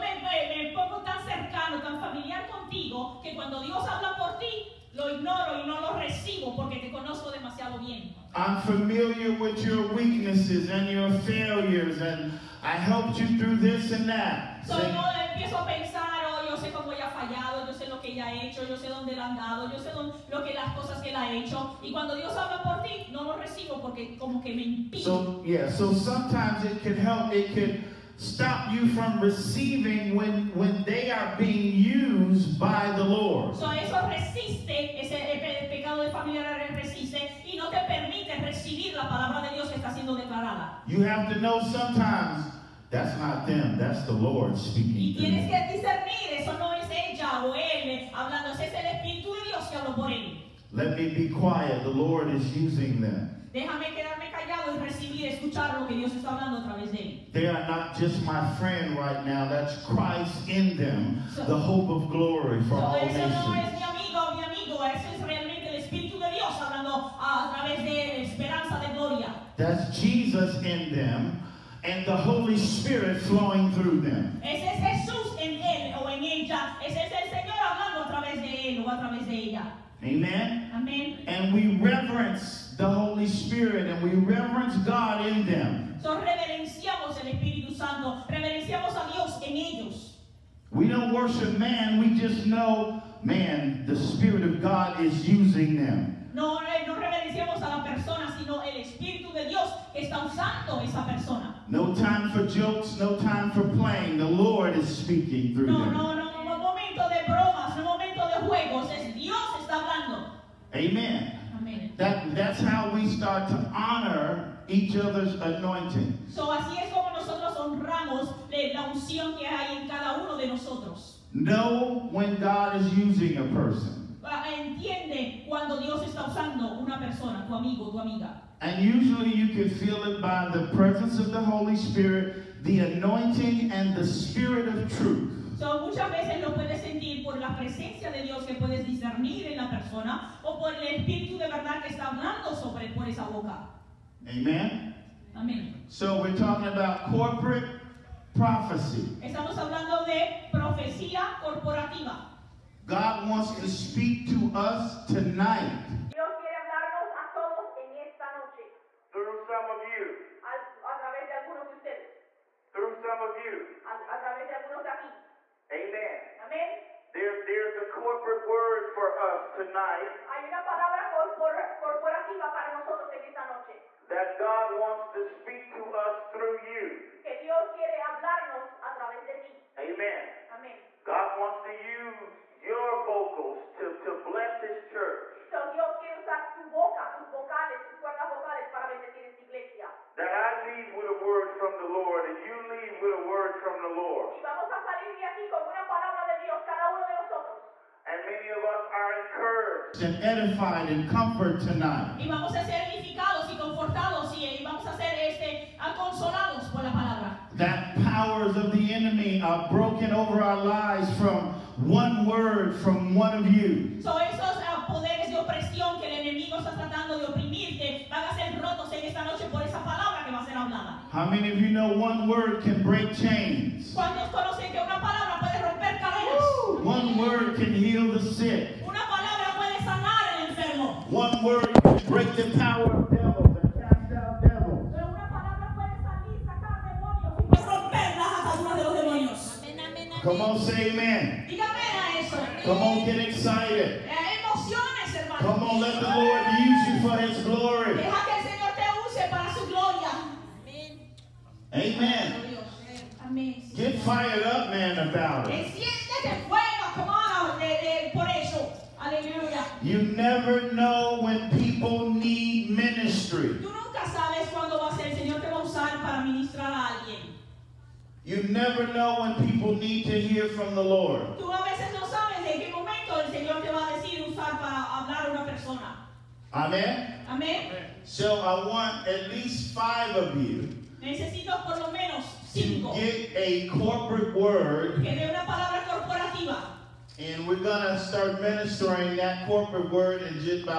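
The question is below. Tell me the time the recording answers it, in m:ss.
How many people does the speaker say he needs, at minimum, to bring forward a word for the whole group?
4:39.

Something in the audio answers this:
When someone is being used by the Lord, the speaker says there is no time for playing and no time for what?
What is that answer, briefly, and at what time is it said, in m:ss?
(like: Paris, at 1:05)
Jokes, at 1:42.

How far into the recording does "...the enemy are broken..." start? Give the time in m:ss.
3:28.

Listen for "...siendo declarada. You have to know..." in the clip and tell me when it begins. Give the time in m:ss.
0:39.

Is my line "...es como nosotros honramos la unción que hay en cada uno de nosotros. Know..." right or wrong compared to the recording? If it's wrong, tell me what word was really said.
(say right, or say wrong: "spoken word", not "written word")
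right.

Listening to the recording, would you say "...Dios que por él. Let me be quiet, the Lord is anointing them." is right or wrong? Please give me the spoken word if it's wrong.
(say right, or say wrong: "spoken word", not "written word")
wrong: "using", not "anointing".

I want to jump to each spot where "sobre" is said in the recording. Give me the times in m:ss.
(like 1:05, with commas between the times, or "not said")
2:22.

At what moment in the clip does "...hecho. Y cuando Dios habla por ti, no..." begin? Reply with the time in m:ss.
0:21.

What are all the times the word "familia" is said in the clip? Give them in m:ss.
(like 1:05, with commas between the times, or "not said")
0:36.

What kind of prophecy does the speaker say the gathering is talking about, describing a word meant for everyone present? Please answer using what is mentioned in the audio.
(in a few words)
Corporate prophecy.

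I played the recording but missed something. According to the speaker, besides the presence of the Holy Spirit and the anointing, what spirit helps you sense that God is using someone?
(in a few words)
The spirit of truth.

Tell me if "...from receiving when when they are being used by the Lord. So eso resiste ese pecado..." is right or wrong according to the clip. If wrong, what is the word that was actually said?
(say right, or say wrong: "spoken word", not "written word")
right.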